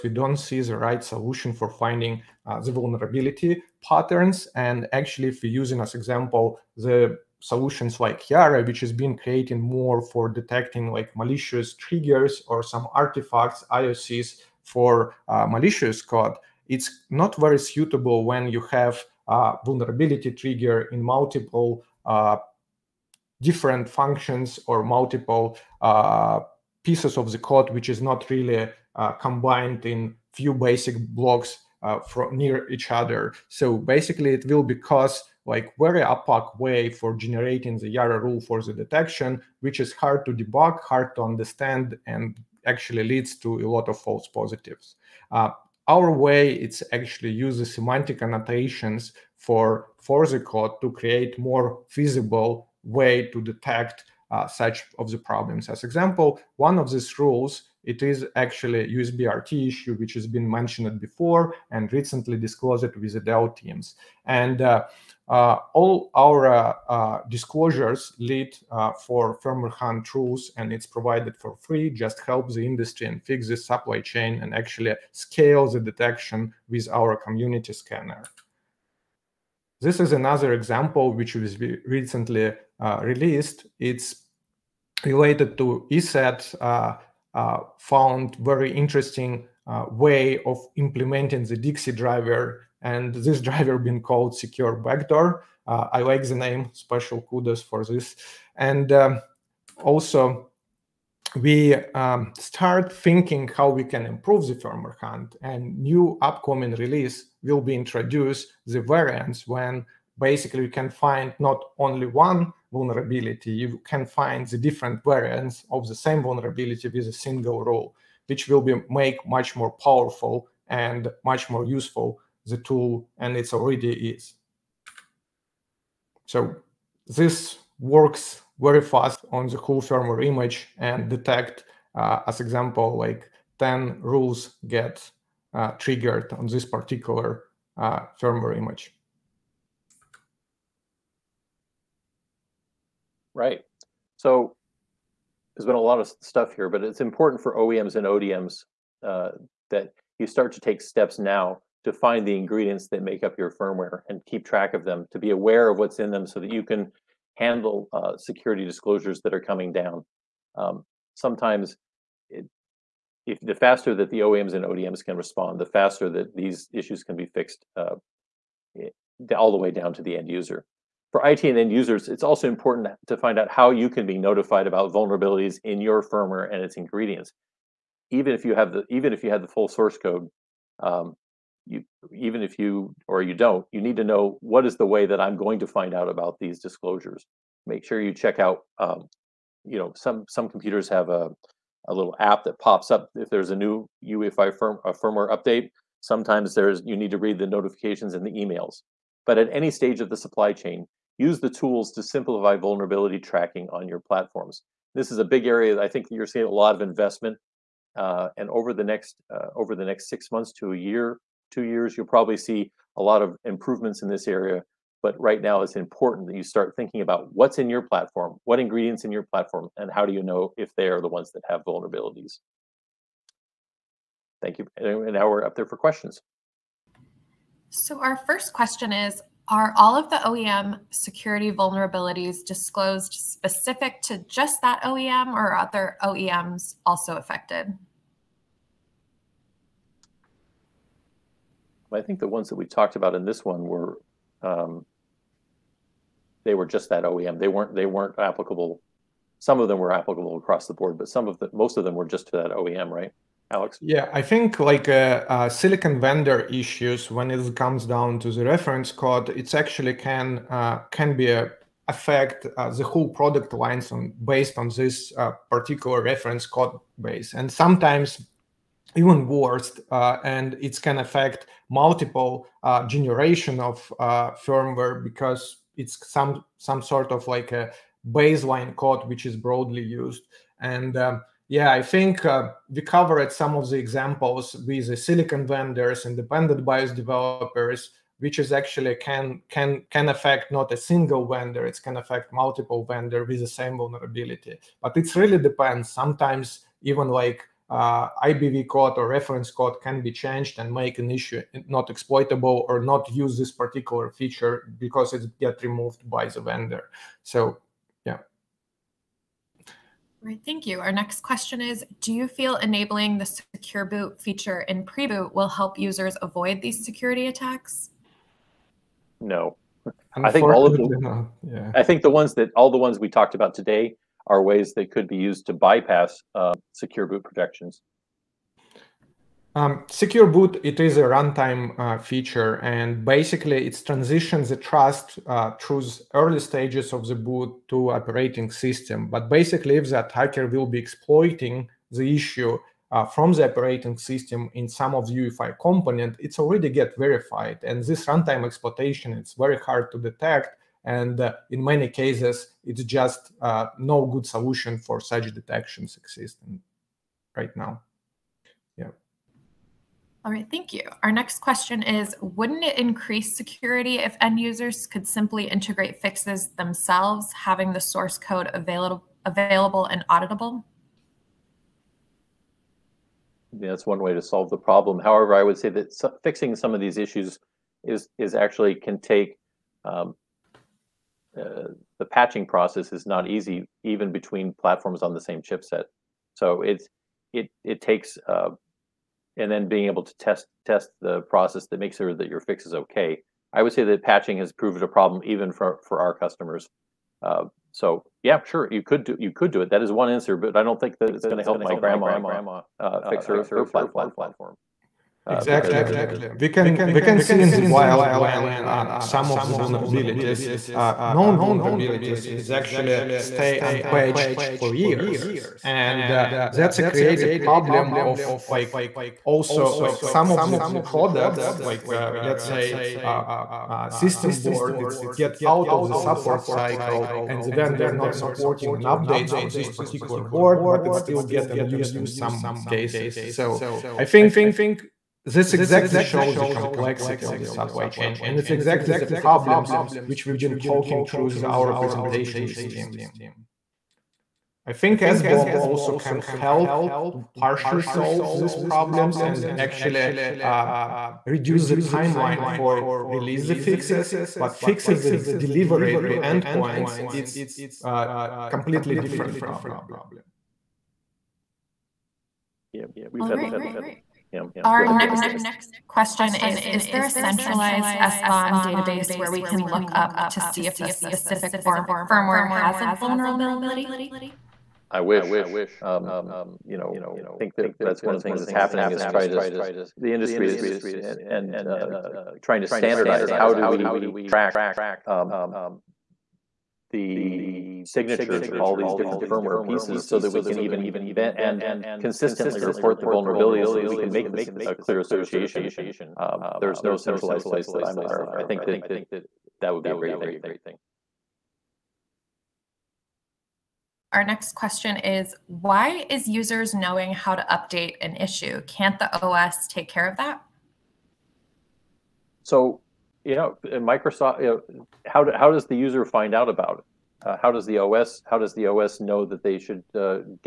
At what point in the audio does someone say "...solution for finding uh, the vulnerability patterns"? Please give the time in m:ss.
0:01.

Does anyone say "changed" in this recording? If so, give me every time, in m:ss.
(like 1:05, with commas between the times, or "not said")
5:00.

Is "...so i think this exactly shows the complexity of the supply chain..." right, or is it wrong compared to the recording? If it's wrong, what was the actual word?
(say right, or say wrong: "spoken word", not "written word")
right.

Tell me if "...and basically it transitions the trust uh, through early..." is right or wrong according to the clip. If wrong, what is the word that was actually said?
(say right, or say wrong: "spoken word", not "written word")
right.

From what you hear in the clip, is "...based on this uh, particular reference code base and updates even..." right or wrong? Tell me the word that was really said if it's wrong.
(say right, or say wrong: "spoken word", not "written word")
wrong: "sometimes", not "updates".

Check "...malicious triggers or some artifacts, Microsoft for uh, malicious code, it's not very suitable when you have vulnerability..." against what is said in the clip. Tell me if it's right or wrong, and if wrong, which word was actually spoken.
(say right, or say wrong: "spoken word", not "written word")
wrong: "IOCs", not "Microsoft".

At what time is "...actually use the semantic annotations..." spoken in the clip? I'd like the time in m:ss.
0:46.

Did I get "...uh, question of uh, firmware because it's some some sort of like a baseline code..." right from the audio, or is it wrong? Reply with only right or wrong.
wrong.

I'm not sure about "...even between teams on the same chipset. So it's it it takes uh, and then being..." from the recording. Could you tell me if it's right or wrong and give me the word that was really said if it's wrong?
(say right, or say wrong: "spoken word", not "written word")
wrong: "platforms", not "teams".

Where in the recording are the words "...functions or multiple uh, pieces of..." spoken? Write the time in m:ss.
0:23.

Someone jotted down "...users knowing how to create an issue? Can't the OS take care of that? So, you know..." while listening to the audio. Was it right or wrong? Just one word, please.
wrong.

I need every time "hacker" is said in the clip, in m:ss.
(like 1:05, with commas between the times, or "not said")
5:40.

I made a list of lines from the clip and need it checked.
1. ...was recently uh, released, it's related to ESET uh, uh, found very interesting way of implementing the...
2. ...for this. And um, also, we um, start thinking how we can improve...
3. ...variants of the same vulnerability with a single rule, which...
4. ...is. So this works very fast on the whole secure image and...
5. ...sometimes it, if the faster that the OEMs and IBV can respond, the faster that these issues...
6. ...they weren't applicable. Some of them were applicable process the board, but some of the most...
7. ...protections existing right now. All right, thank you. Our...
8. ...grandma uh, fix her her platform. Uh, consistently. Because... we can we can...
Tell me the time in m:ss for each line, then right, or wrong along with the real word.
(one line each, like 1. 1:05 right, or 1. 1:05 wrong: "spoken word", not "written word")
1. 1:21 right
2. 1:37 right
3. 1:55 right
4. 2:04 wrong: "firmware", not "secure"
5. 2:41 wrong: "ODMs", not "IBV"
6. 4:07 wrong: "across", not "process"
7. 5:55 wrong: "detections", not "protections"
8. 6:41 wrong: "exactly", not "consistently".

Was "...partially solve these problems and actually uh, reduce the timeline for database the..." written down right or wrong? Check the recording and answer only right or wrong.
wrong.